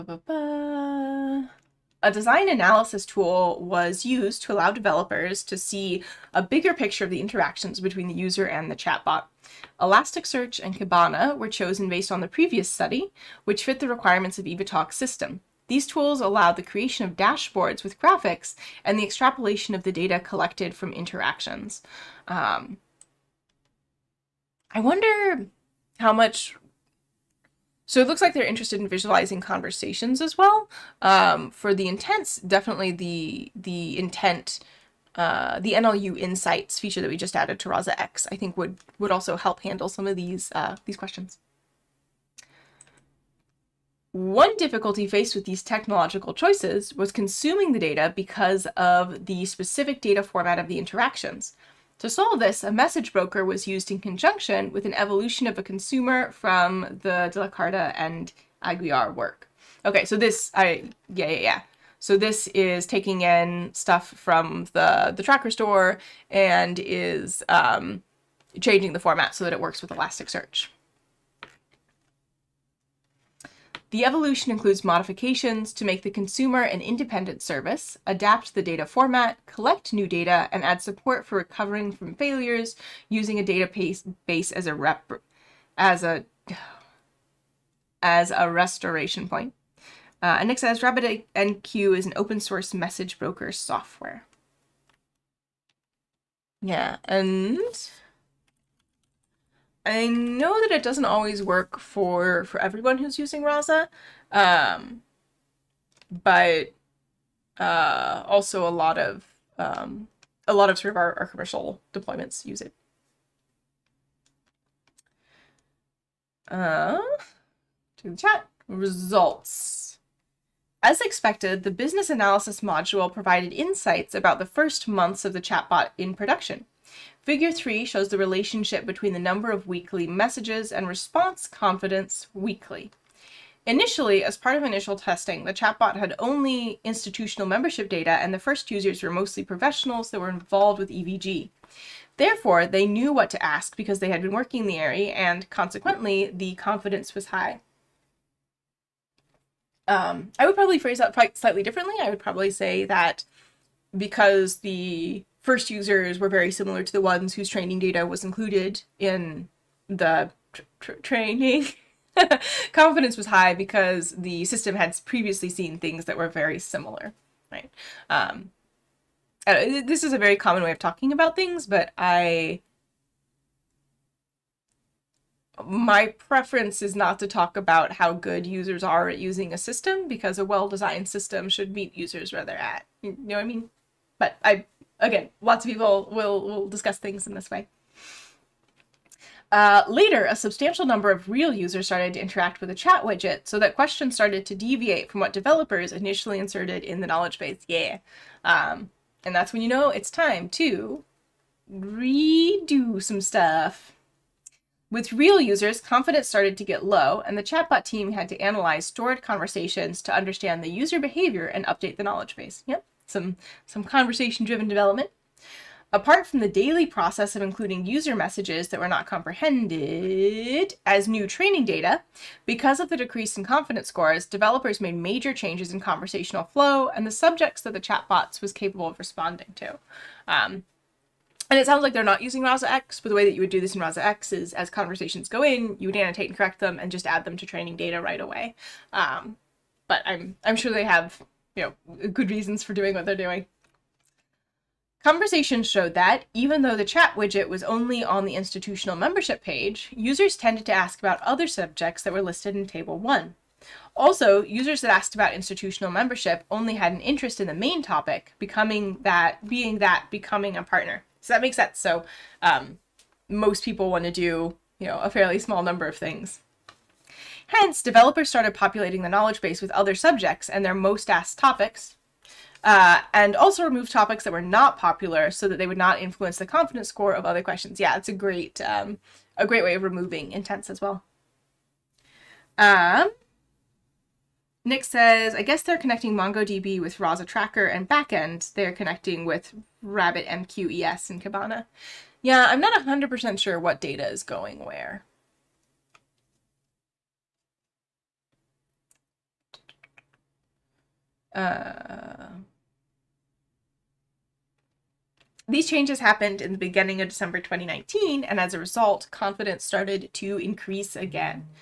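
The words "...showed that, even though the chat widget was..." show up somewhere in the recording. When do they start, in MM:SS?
04:05.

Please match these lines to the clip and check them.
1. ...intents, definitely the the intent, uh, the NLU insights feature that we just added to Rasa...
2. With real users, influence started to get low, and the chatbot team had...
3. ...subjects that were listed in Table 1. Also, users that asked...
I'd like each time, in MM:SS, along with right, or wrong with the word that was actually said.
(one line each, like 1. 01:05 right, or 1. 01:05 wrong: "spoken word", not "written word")
1. 00:31 right
2. 03:24 wrong: "confidence", not "influence"
3. 04:11 right.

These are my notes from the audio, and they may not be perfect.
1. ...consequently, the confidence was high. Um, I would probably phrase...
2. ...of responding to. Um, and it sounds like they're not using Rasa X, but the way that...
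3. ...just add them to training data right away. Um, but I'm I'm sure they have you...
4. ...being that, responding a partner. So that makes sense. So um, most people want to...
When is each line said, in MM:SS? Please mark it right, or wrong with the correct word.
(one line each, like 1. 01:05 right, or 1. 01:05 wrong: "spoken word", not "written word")
1. 02:25 right
2. 03:48 right
3. 03:56 right
4. 04:19 wrong: "becoming", not "responding".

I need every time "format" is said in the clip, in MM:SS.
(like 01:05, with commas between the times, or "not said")
00:50, 01:08, 01:18.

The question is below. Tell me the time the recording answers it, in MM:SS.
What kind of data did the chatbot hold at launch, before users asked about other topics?
02:16.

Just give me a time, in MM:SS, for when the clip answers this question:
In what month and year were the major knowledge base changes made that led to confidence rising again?
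05:07.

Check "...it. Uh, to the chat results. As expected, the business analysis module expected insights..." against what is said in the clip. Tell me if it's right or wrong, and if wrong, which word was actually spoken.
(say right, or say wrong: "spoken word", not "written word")
wrong: "provided", not "expected".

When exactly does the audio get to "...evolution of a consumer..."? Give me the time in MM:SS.
00:54.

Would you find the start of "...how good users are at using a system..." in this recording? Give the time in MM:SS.
02:57.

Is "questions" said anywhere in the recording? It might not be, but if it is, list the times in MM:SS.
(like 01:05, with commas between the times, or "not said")
00:40, 03:13, 04:37.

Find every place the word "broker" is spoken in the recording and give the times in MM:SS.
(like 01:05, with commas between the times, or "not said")
00:53, 01:33.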